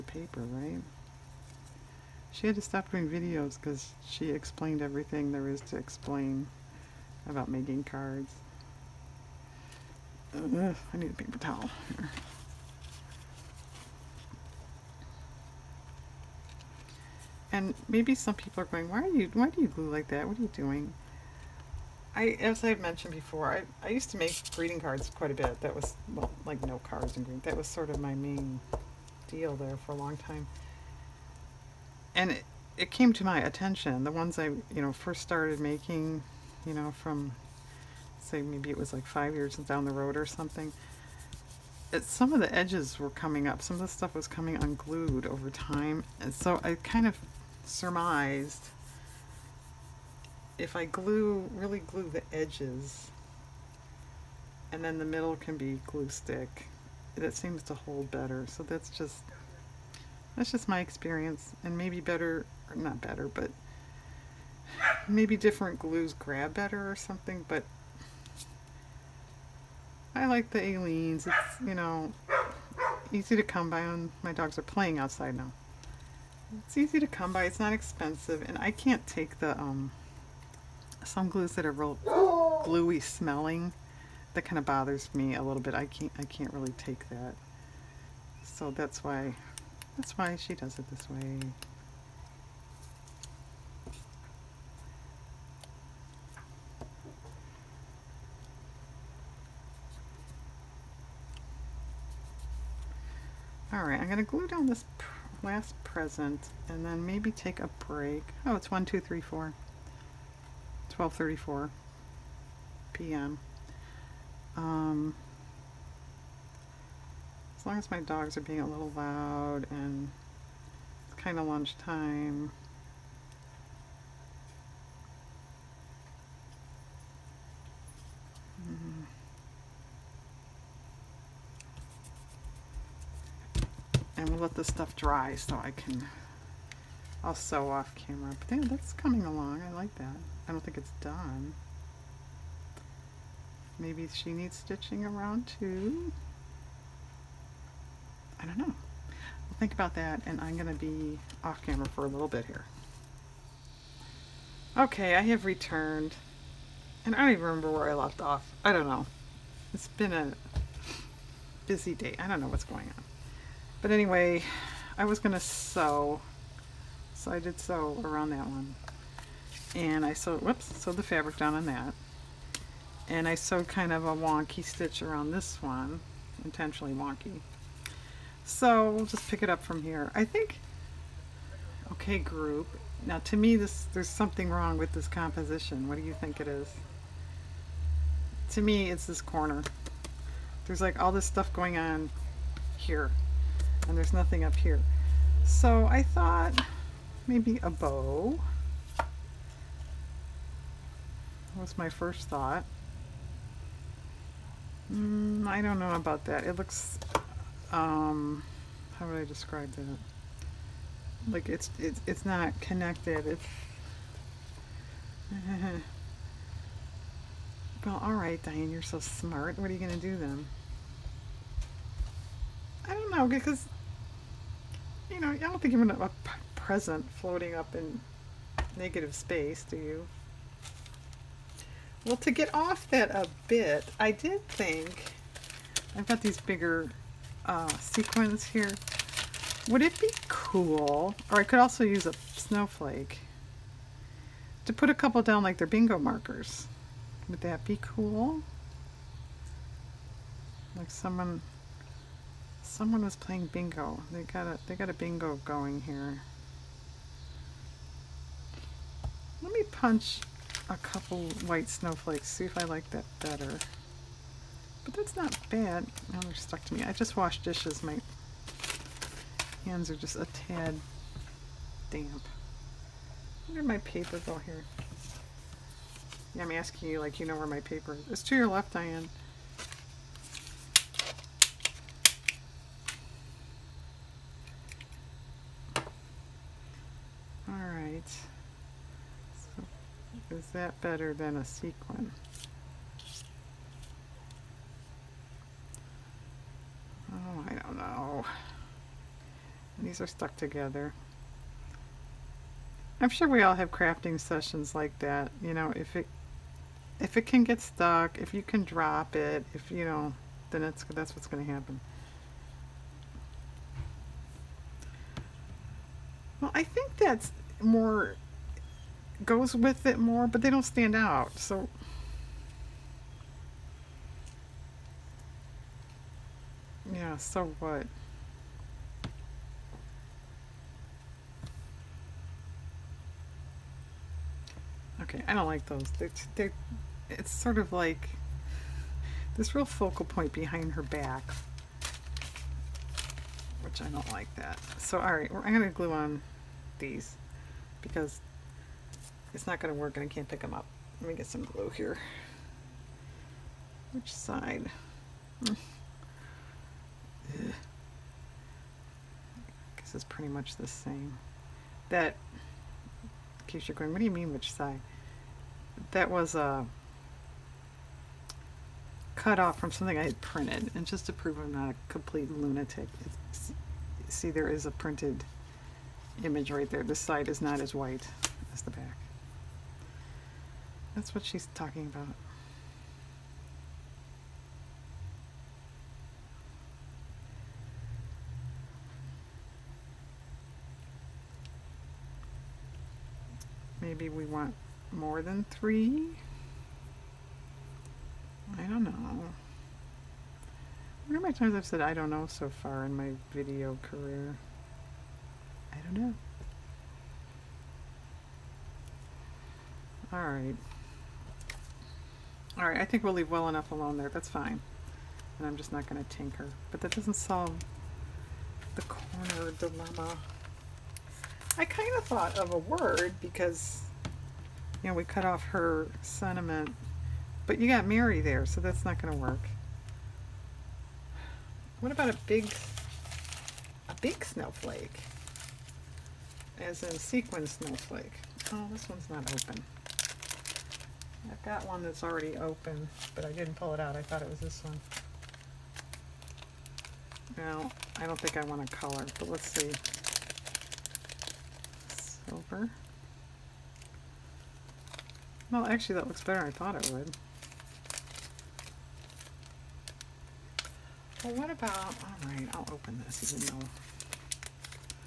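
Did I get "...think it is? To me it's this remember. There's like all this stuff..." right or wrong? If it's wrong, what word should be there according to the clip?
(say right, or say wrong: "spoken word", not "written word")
wrong: "corner", not "remember".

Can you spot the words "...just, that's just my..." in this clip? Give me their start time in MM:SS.
00:58.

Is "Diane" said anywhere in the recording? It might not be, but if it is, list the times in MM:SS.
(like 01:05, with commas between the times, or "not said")
03:38, 04:38.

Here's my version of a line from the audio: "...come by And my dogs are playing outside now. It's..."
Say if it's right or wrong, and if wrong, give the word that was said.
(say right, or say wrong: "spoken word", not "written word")
right.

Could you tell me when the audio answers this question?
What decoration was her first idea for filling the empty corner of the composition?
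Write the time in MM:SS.
03:17.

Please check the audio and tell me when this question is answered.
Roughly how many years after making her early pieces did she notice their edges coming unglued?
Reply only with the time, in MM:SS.
00:39.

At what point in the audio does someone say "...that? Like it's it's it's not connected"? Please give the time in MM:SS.
03:29.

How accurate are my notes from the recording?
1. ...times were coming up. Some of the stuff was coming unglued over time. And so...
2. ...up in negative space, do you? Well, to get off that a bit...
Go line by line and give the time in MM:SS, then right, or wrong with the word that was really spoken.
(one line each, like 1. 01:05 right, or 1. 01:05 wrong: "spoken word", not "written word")
1. 00:42 wrong: "edges", not "times"
2. 03:47 right.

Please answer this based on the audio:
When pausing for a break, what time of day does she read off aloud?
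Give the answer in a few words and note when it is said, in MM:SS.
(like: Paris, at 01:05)
12:34 p.m., at 01:50.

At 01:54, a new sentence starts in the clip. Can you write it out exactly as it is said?
Um, as long as my dogs are being a little loud and it's kind of lunchtime.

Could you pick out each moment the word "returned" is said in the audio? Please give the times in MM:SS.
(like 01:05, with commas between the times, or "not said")
02:35.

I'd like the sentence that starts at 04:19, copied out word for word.
Let me punch a couple white snowflakes, see if I like that better.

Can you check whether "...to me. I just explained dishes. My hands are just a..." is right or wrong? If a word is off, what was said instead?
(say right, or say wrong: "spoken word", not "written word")
wrong: "washed", not "explained".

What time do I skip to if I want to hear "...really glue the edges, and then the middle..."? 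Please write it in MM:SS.
00:51.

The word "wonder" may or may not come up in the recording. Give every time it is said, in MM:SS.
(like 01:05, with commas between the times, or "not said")
06:41.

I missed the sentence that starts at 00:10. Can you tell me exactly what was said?
Ugh, I need a paper towel.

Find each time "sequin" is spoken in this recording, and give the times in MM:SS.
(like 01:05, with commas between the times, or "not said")
03:57, 04:51, 07:16.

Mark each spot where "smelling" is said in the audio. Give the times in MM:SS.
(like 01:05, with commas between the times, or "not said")
01:23.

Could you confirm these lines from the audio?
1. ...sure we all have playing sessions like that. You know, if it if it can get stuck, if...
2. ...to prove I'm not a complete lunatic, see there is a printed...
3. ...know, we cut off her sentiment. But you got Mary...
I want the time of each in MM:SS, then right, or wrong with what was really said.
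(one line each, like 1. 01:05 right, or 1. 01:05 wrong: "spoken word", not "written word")
1. 05:03 wrong: "crafting", not "playing"
2. 06:11 right
3. 07:04 right.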